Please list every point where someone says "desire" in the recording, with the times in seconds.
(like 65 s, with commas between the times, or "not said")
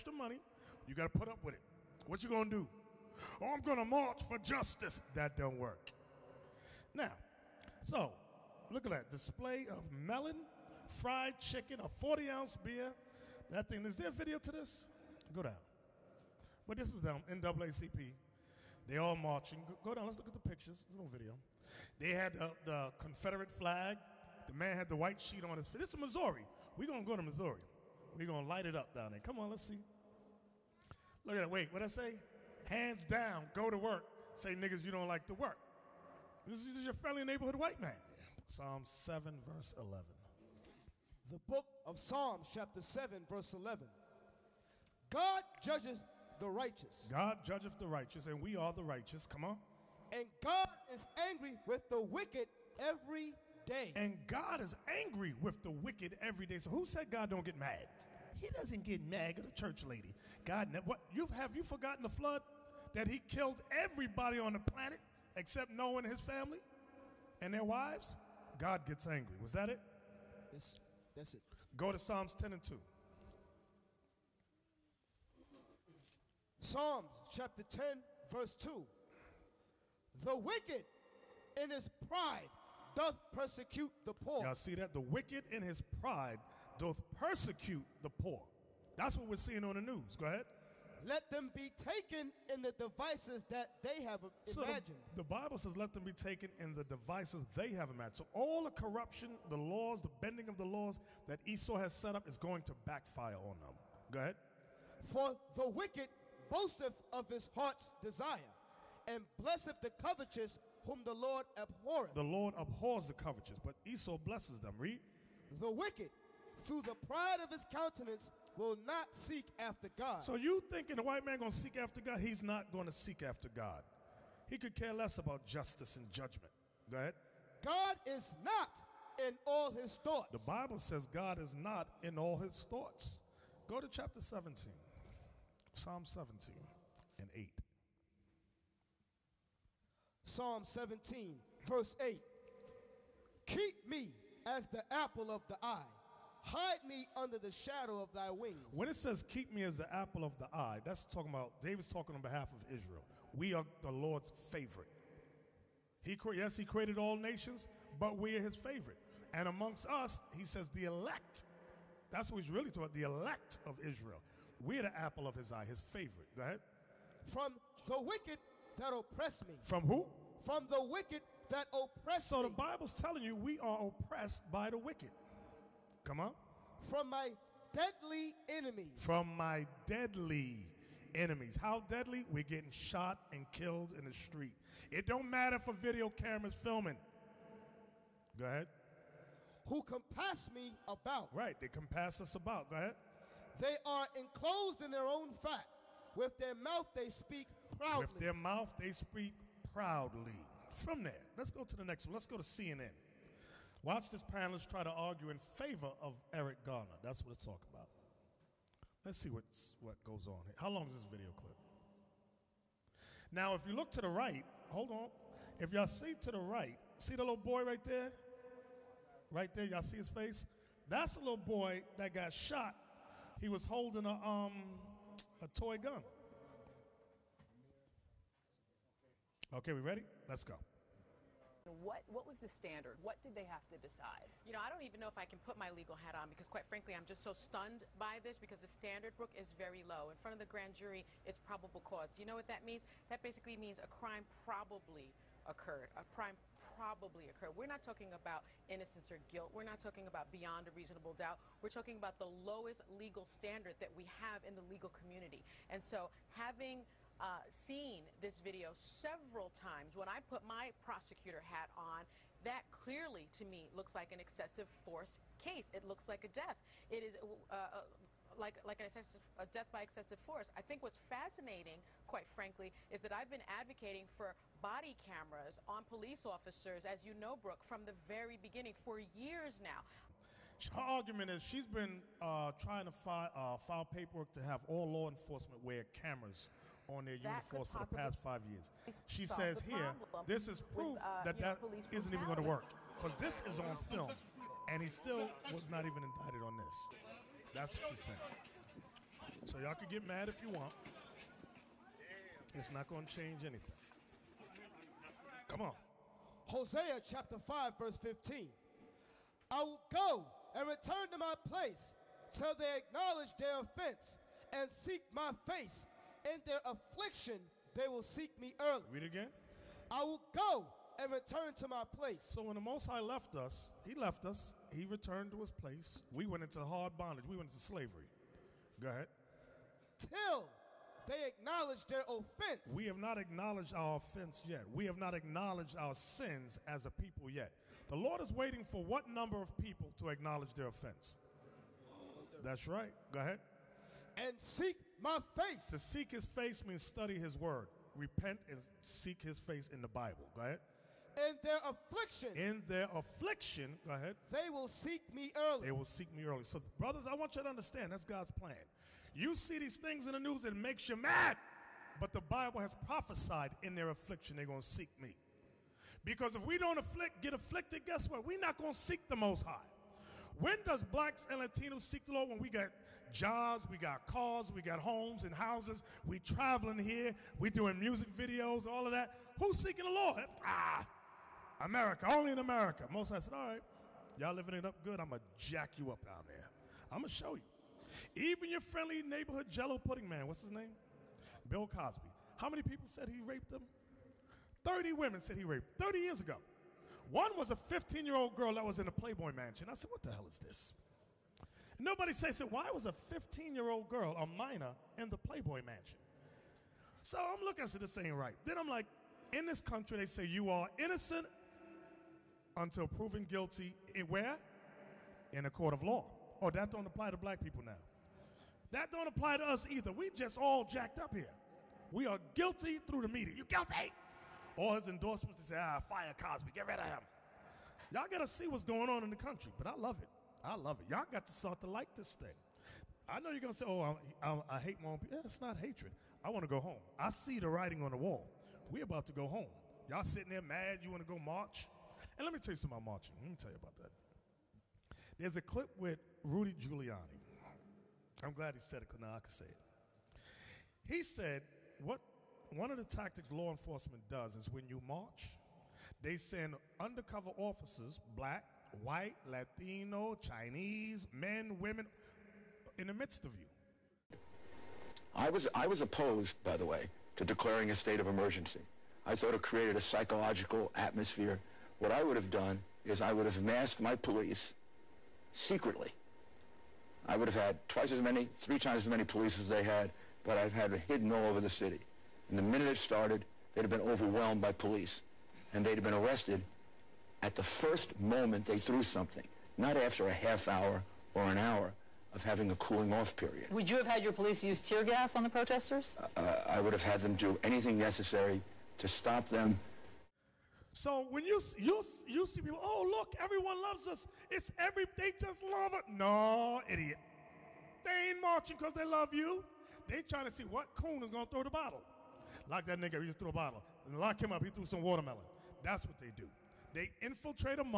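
108 s.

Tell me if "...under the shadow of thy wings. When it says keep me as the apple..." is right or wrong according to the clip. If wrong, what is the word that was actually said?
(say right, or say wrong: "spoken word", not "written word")
right.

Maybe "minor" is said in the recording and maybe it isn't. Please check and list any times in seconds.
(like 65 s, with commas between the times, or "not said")
404 s.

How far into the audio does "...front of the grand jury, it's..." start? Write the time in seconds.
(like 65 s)
240 s.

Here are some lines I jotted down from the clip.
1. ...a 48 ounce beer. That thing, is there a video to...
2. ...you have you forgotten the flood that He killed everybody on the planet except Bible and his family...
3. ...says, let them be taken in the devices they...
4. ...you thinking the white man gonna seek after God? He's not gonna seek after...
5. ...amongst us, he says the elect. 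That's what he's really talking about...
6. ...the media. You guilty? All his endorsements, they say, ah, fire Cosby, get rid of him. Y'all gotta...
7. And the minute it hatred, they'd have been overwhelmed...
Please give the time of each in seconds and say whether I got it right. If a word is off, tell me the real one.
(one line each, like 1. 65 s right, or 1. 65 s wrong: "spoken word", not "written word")
1. 11 s wrong: "40", not "48"
2. 61 s wrong: "Noah", not "Bible"
3. 95 s right
4. 120 s right
5. 159 s right
6. 423 s right
7. 482 s wrong: "started", not "hatred".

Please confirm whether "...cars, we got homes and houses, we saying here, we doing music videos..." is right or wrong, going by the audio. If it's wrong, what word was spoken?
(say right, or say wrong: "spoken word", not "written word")
wrong: "traveling", not "saying".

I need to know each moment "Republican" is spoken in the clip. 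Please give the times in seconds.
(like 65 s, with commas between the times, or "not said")
not said.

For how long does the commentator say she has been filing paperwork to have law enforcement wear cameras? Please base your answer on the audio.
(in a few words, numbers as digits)
5 years.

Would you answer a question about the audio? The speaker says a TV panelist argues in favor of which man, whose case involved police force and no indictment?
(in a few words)
Eric Garner.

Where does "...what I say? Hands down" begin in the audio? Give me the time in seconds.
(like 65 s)
31 s.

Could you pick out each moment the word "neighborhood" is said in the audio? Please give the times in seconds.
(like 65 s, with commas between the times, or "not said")
37 s, 389 s.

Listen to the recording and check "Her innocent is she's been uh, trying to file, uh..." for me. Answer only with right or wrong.
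wrong.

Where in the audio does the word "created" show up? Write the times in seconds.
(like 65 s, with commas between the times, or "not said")
156 s, 469 s.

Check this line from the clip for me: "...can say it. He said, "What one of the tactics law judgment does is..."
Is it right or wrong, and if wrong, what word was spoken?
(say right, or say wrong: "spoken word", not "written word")
wrong: "enforcement", not "judgment".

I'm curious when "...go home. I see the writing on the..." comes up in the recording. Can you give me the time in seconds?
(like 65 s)
436 s.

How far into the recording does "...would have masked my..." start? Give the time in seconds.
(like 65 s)
473 s.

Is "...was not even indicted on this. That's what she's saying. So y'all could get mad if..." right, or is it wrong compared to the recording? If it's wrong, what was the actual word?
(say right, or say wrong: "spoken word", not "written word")
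right.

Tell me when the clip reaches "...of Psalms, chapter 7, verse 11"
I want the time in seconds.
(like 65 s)
41 s.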